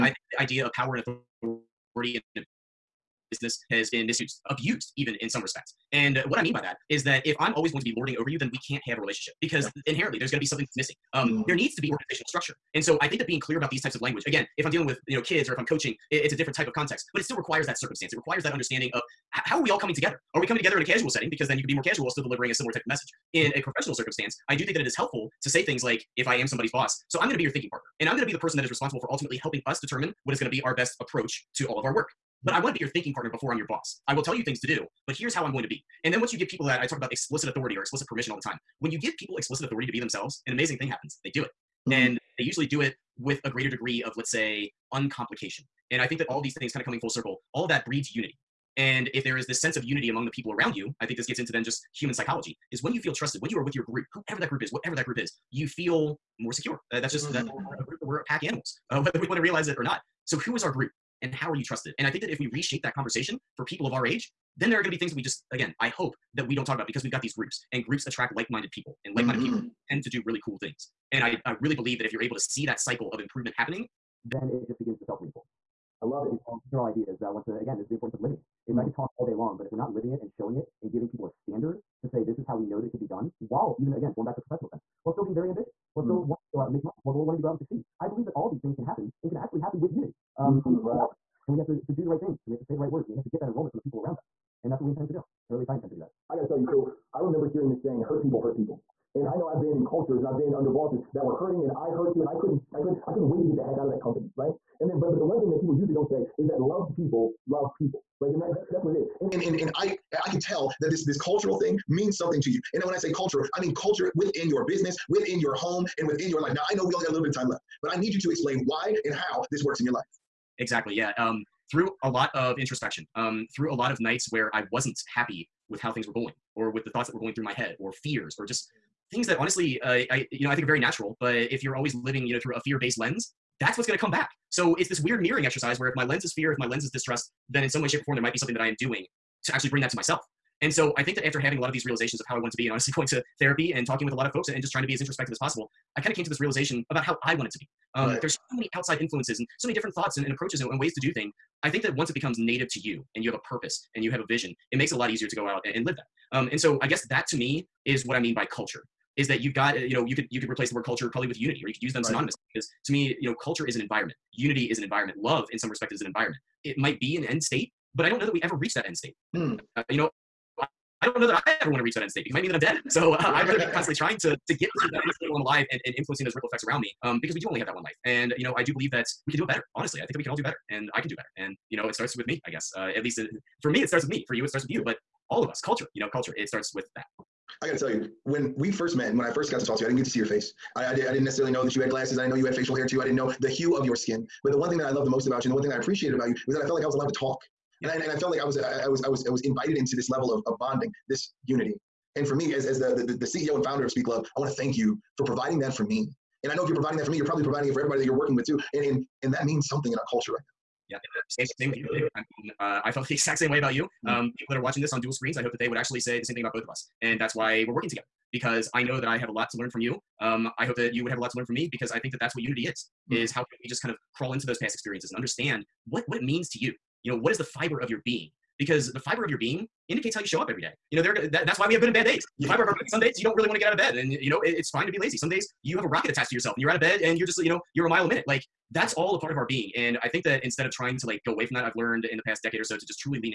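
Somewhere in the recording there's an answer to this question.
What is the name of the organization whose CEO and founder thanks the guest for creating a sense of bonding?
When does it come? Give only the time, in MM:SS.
03:23.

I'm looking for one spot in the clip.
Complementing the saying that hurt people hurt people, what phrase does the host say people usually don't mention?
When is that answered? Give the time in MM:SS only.
01:46.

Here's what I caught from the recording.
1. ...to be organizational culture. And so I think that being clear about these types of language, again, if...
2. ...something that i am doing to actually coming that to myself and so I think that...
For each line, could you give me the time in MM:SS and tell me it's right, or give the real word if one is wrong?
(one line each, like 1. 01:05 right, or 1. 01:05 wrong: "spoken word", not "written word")
1. 00:11 wrong: "structure", not "culture"
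2. 02:18 wrong: "bring", not "coming".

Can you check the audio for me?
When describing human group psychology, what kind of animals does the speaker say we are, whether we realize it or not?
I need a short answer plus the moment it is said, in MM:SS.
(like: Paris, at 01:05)
pack animals, at 00:58.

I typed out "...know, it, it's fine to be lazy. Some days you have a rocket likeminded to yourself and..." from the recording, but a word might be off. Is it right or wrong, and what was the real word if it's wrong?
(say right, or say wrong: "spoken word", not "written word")
wrong: "attached", not "likeminded".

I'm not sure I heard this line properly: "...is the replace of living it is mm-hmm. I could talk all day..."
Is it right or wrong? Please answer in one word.
wrong.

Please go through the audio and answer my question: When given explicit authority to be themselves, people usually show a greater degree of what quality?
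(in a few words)
uncomplication.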